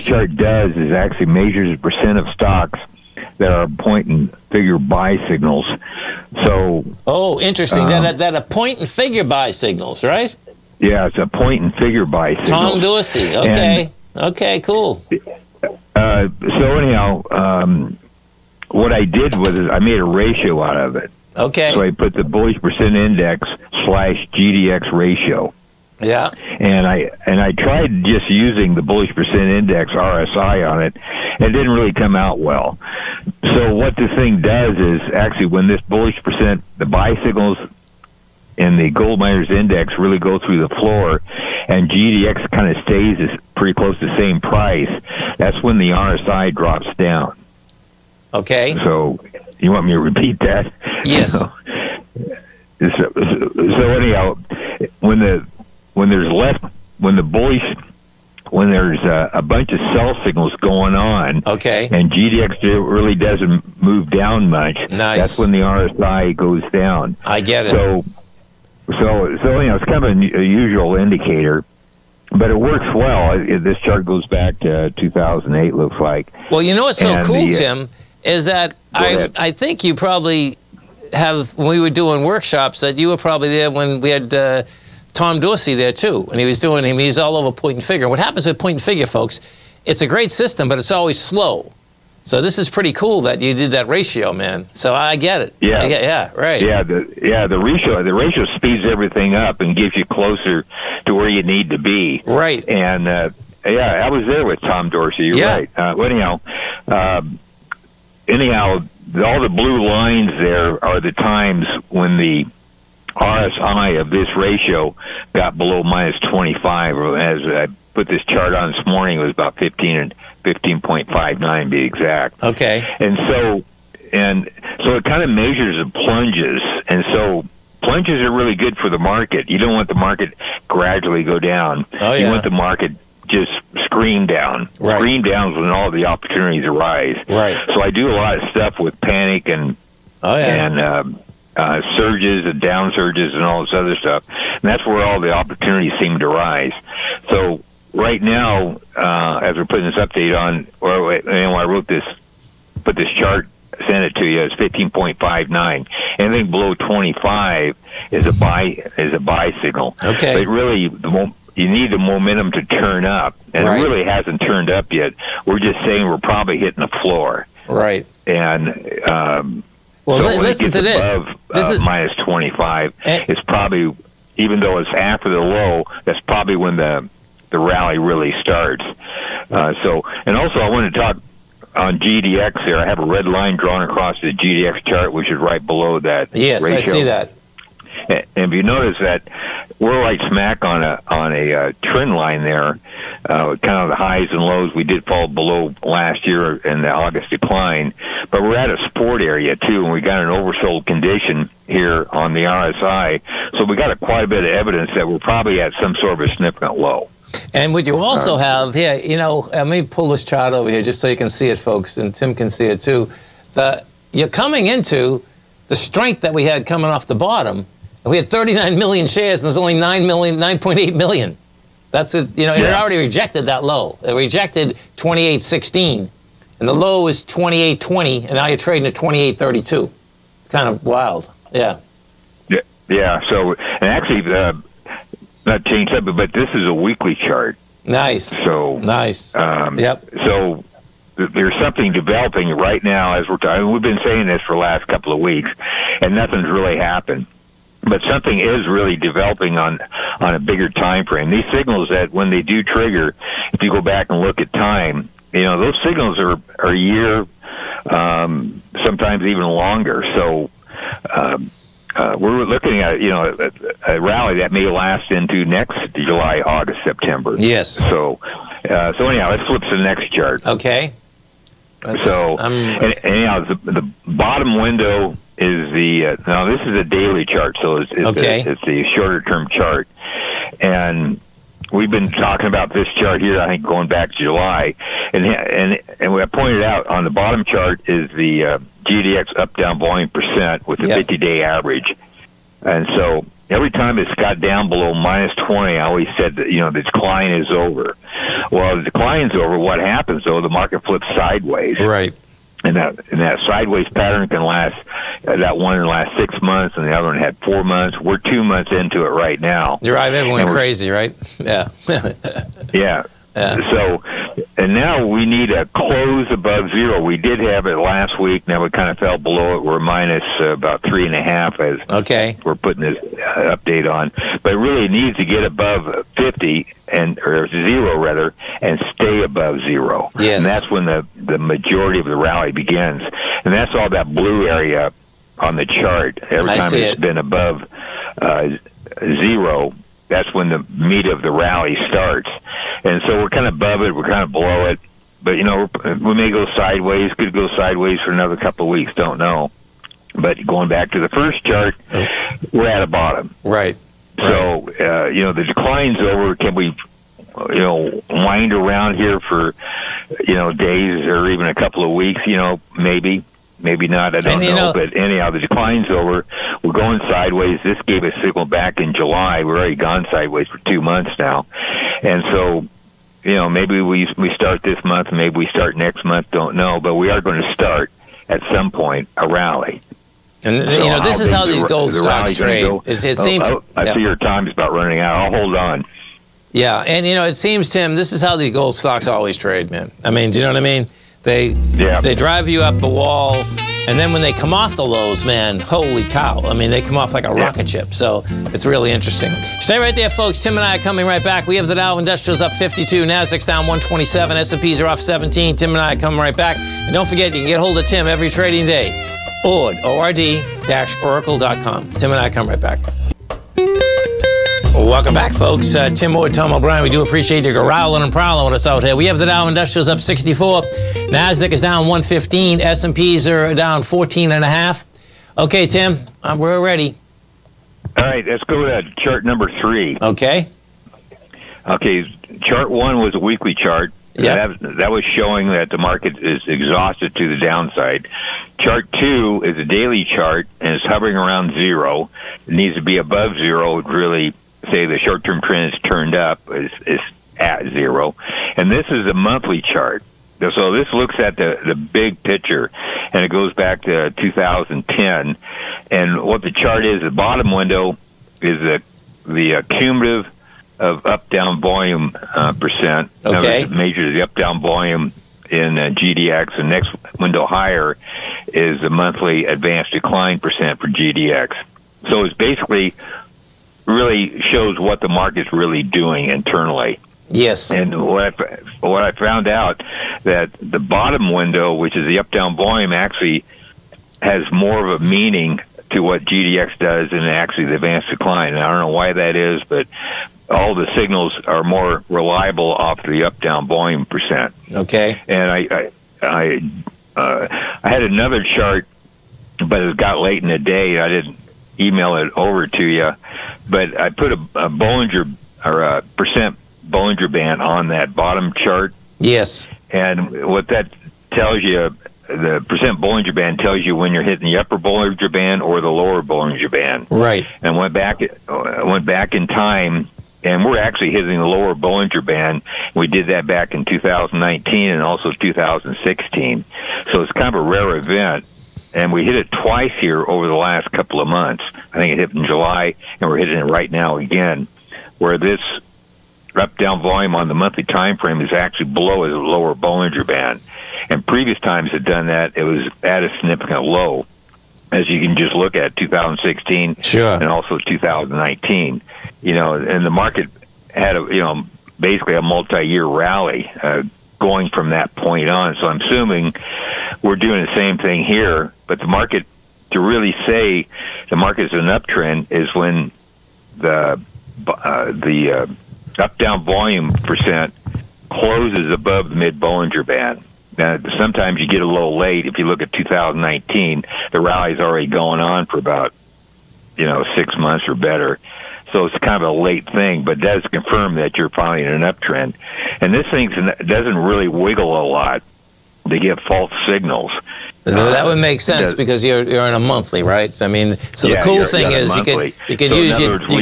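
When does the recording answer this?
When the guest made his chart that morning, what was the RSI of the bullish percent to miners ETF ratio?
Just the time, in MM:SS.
02:00.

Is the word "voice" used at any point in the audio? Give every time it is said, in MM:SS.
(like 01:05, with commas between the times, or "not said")
00:57.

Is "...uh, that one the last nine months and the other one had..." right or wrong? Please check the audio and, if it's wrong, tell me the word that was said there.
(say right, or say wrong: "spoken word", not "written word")
wrong: "six", not "nine".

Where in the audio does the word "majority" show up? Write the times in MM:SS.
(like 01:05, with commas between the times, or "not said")
05:31.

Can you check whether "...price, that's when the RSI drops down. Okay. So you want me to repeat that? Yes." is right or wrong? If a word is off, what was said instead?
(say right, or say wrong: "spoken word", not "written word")
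right.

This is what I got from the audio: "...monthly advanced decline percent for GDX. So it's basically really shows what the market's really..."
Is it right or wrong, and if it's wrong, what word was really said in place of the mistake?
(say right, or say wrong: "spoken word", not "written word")
right.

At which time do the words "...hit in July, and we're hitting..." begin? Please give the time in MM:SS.
08:52.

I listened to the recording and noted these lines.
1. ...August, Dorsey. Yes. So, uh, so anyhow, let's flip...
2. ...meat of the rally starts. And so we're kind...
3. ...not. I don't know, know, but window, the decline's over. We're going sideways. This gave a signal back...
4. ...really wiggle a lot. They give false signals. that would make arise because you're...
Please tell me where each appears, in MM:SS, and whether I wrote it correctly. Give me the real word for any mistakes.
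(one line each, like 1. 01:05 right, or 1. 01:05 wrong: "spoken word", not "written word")
1. 04:26 wrong: "September", not "Dorsey"
2. 05:40 right
3. 06:03 wrong: "anyhow", not "window"
4. 09:44 wrong: "sense", not "arise".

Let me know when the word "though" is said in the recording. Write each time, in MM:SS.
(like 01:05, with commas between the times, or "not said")
02:54, 05:00.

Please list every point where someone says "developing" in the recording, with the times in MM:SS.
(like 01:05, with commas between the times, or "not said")
04:01, 04:08.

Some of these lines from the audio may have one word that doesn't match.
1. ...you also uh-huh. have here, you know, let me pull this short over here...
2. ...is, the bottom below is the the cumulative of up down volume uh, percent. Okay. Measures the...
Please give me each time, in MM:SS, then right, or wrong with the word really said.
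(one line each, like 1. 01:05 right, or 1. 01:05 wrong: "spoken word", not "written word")
1. 03:27 wrong: "chart", not "short"
2. 07:36 wrong: "window", not "below".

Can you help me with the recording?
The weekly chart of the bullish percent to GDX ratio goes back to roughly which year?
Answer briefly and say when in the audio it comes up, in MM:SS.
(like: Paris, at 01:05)
2008, at 01:14.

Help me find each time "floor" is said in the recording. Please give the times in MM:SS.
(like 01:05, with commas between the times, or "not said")
00:40, 02:47.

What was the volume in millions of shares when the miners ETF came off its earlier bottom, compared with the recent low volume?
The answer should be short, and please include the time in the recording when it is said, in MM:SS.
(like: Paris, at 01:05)
39 million, at 03:38.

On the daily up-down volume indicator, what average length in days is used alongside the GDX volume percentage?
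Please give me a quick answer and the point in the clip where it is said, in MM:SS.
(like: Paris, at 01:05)
50 day, at 04:51.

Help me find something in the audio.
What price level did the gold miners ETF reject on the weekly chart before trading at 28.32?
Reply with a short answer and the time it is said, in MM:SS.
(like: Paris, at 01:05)
28.16, at 03:44.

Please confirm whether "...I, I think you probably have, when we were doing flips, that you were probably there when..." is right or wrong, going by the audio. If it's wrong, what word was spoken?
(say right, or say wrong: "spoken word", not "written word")
wrong: "workshops", not "flips".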